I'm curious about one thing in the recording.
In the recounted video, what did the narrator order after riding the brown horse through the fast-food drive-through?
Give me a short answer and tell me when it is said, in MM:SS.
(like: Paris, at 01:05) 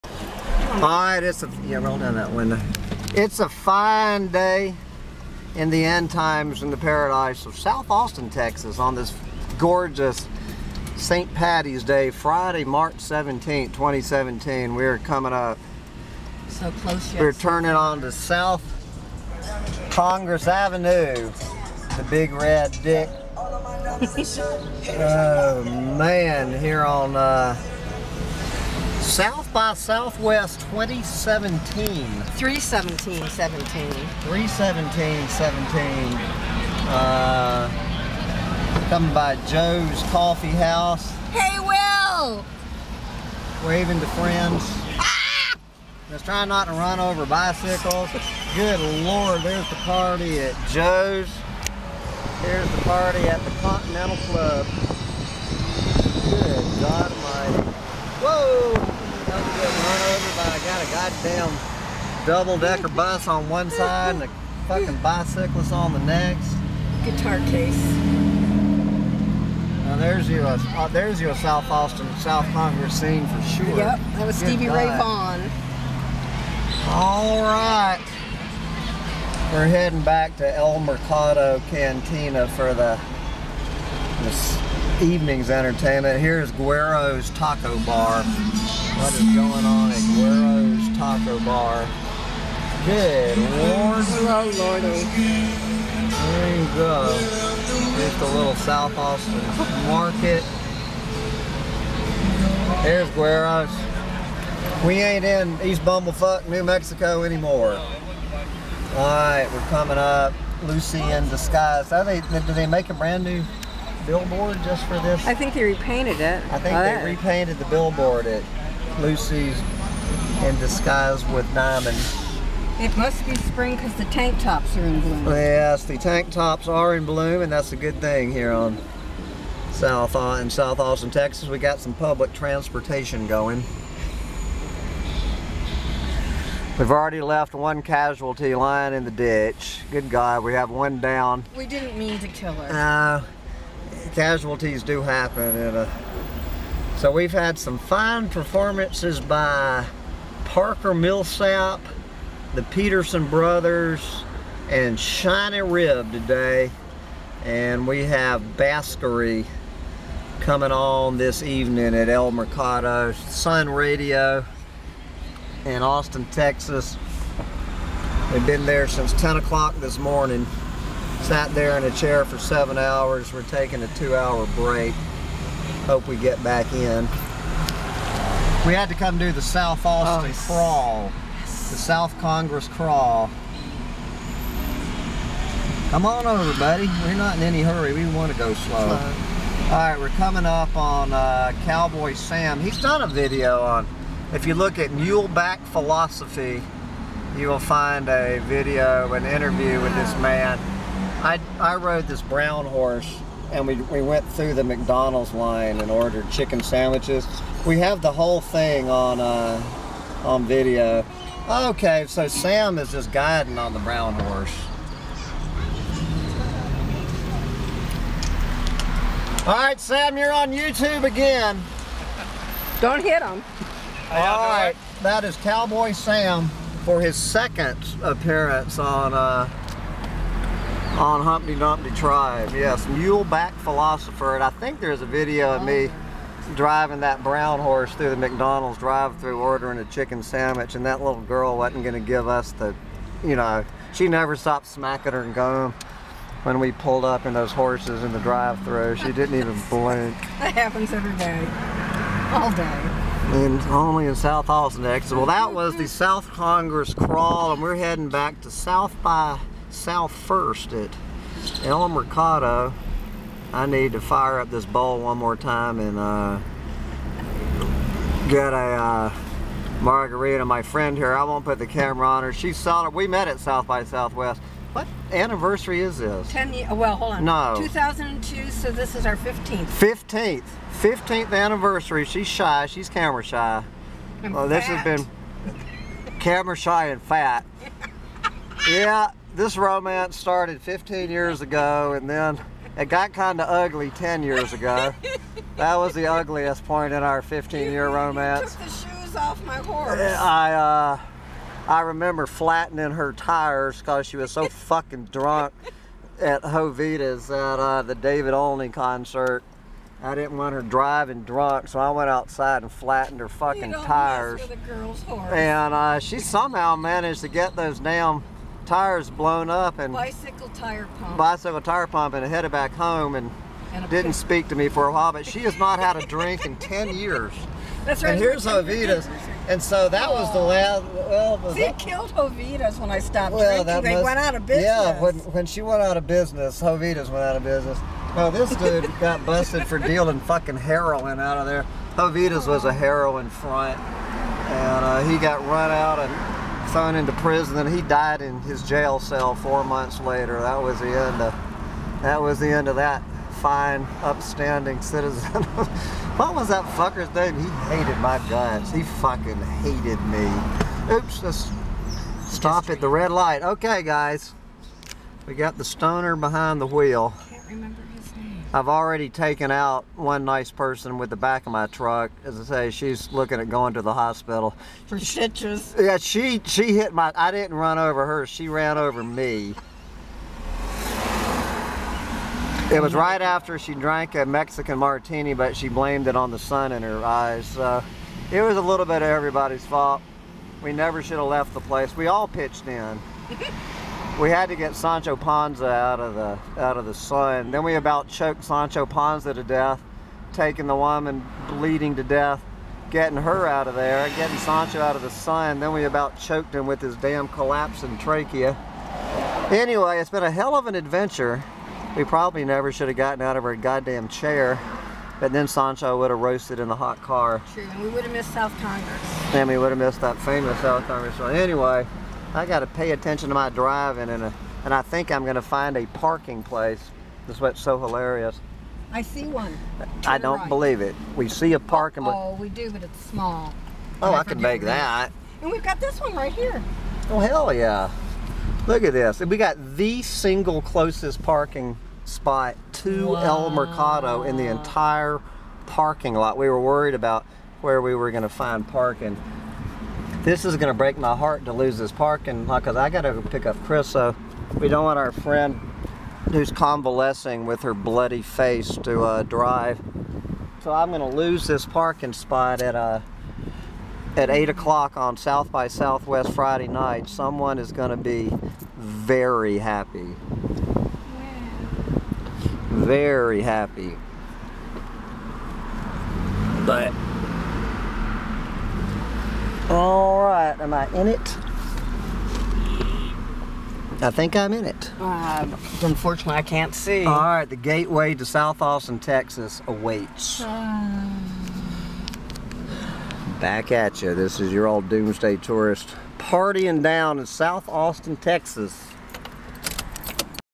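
Chicken sandwiches, at 03:26.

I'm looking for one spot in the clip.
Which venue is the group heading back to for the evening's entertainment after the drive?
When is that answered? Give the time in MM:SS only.
01:20.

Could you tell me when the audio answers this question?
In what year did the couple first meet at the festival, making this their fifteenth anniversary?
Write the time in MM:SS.
04:37.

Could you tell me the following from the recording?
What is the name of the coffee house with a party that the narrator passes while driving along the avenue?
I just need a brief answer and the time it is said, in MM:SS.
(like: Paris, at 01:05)
Joe's Coffee House, at 00:39.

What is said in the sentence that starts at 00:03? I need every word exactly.
It's a fine day in the end times in the paradise of South Austin, Texas on this gorgeous St.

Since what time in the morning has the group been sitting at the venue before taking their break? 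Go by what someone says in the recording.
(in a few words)
10 o'clock.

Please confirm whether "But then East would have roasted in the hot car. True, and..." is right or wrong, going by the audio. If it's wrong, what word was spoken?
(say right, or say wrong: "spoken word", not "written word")
wrong: "Sancho", not "East".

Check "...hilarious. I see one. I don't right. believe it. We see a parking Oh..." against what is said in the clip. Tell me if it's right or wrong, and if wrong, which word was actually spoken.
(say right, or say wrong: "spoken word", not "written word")
right.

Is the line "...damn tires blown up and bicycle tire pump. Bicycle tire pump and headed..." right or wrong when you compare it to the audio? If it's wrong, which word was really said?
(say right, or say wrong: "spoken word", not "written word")
right.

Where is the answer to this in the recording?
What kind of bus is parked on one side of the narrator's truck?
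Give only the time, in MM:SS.
01:02.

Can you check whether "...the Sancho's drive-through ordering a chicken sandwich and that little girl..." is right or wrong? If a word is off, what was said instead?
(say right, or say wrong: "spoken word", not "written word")
wrong: "McDonald", not "Sancho".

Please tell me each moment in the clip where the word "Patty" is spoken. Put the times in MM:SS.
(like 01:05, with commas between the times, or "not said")
00:11.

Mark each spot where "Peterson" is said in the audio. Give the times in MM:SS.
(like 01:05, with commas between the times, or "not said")
02:32.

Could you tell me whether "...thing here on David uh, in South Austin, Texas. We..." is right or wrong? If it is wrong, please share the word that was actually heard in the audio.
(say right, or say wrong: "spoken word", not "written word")
wrong: "South", not "David".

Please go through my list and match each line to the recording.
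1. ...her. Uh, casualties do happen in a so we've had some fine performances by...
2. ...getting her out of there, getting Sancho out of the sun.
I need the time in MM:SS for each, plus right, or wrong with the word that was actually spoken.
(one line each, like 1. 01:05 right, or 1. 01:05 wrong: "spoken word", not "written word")
1. 02:22 right
2. 06:42 right.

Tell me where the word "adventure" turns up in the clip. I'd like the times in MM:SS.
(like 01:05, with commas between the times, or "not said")
06:50.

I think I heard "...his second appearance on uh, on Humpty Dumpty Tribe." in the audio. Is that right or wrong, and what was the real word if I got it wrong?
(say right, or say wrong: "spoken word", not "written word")
right.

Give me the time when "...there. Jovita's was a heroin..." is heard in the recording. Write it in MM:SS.
05:41.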